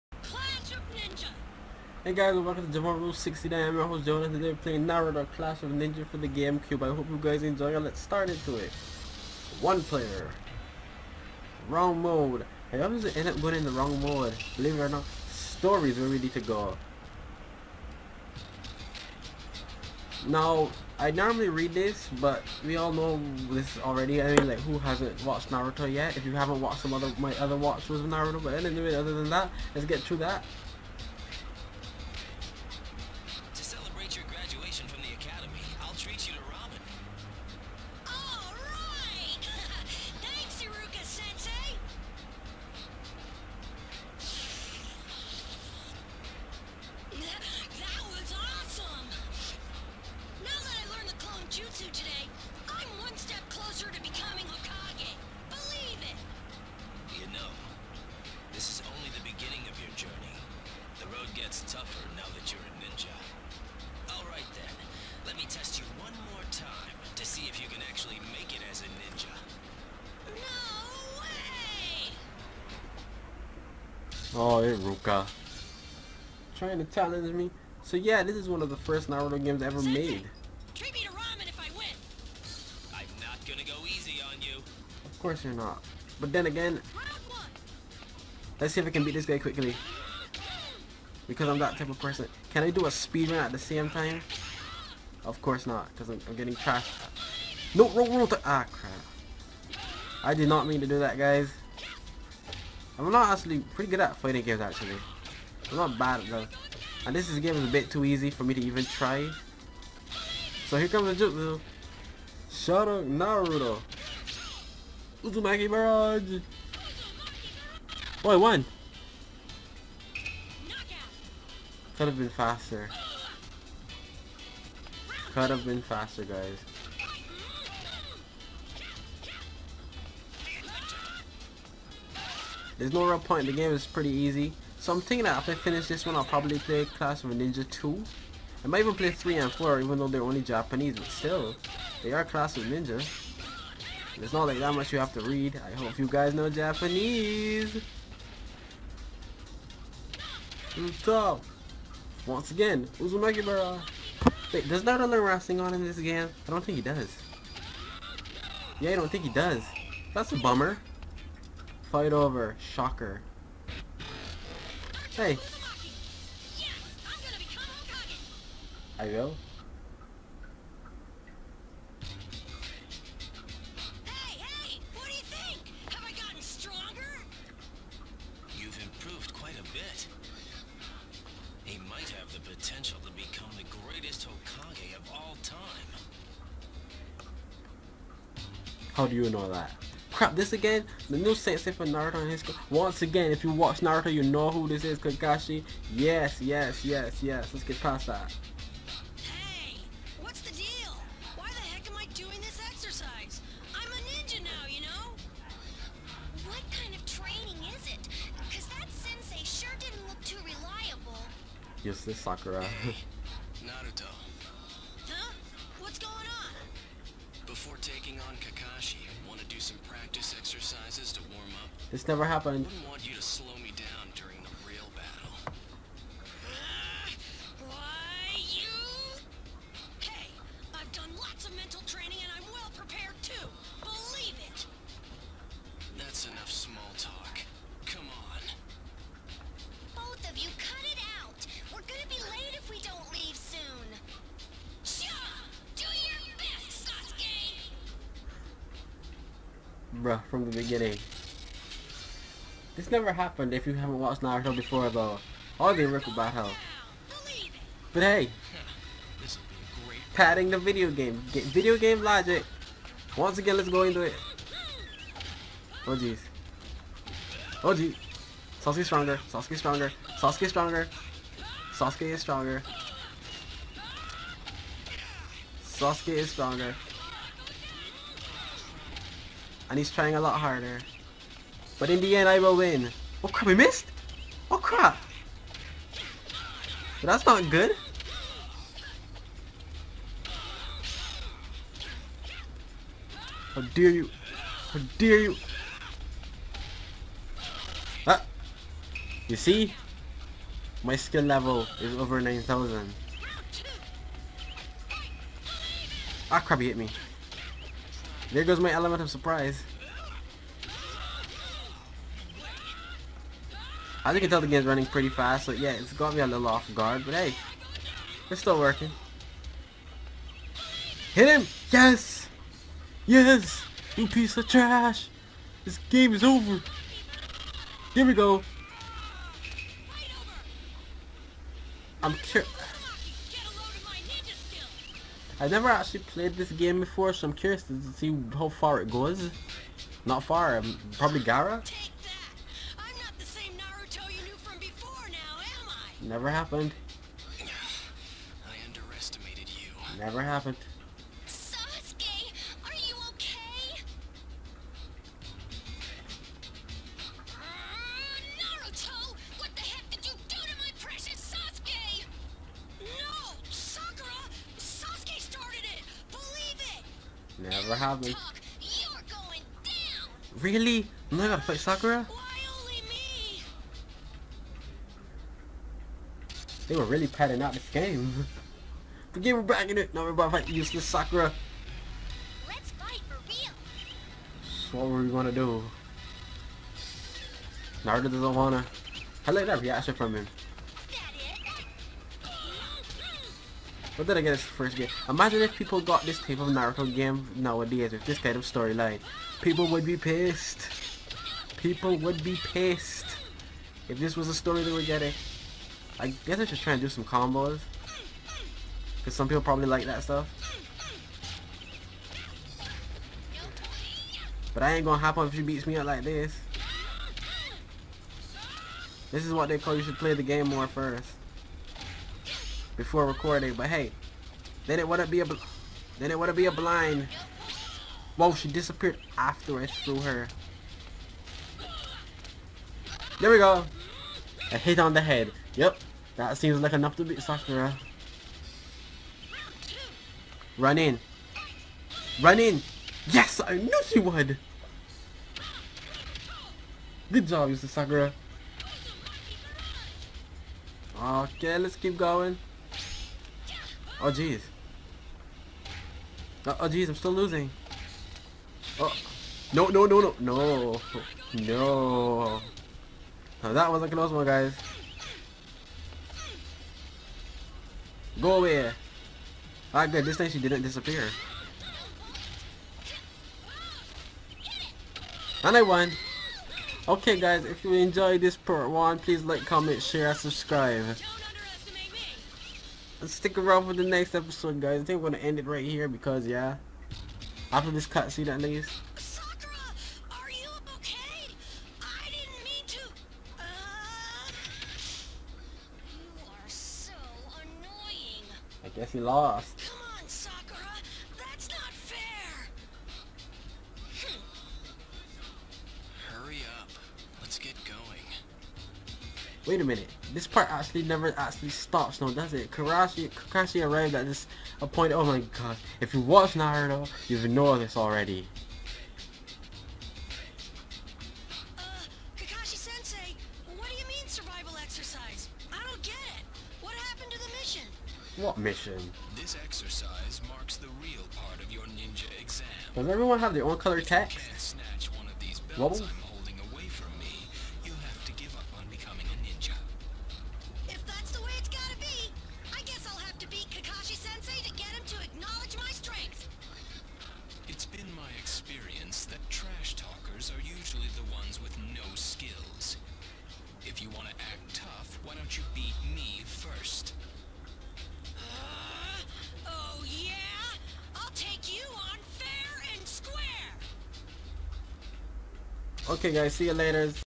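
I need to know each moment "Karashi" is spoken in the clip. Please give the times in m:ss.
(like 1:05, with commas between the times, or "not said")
8:32.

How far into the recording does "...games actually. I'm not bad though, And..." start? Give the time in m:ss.
1:44.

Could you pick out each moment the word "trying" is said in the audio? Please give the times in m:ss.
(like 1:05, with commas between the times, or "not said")
1:16, 4:39.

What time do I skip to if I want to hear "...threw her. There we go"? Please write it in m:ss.
7:09.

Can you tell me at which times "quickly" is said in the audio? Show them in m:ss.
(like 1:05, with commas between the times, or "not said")
1:29.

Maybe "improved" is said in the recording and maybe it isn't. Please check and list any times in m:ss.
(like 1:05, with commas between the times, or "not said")
2:58.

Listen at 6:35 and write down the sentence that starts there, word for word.
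Imagine if people got this type of Naruto game nowadays with this kind of storyline.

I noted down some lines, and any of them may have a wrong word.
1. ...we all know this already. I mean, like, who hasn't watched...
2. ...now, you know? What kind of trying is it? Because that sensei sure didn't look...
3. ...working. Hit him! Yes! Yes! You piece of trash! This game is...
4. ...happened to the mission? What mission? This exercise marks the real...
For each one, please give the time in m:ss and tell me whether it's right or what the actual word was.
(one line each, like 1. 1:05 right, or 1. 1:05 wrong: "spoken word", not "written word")
1. 0:22 right
2. 3:24 wrong: "training", not "trying"
3. 5:18 right
4. 8:46 right.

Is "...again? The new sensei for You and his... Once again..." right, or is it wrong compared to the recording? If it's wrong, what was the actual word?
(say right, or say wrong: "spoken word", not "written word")
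wrong: "Naruto", not "You".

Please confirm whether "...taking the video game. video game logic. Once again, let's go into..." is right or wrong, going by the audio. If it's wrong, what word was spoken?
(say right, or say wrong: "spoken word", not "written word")
wrong: "padding", not "taking".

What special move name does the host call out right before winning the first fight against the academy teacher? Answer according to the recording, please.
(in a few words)
Uzumaki Barrage.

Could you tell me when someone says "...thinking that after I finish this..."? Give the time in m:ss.
2:15.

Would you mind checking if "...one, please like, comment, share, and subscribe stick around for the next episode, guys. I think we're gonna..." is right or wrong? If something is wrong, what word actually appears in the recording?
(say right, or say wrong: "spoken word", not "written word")
right.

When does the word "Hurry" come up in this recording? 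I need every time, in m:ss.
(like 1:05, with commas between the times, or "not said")
8:26.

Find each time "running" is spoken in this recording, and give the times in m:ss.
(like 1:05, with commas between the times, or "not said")
5:14.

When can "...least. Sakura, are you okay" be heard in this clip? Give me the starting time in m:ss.
8:08.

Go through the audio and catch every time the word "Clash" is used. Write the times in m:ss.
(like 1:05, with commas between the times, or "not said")
0:05, 2:16, 2:22.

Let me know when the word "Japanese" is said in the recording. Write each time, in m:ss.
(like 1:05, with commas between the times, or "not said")
2:20, 2:26.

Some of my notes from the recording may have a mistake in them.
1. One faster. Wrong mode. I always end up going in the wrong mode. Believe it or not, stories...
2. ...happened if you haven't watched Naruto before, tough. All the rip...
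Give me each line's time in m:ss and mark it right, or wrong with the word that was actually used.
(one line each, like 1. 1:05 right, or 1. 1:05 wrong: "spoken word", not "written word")
1. 0:09 wrong: "player", not "faster"
2. 4:13 wrong: "though", not "tough".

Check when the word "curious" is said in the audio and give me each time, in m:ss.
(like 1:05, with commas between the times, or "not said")
5:32, 5:37.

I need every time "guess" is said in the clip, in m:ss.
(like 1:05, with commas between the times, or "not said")
6:46, 8:18.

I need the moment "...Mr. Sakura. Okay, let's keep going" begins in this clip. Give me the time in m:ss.
7:27.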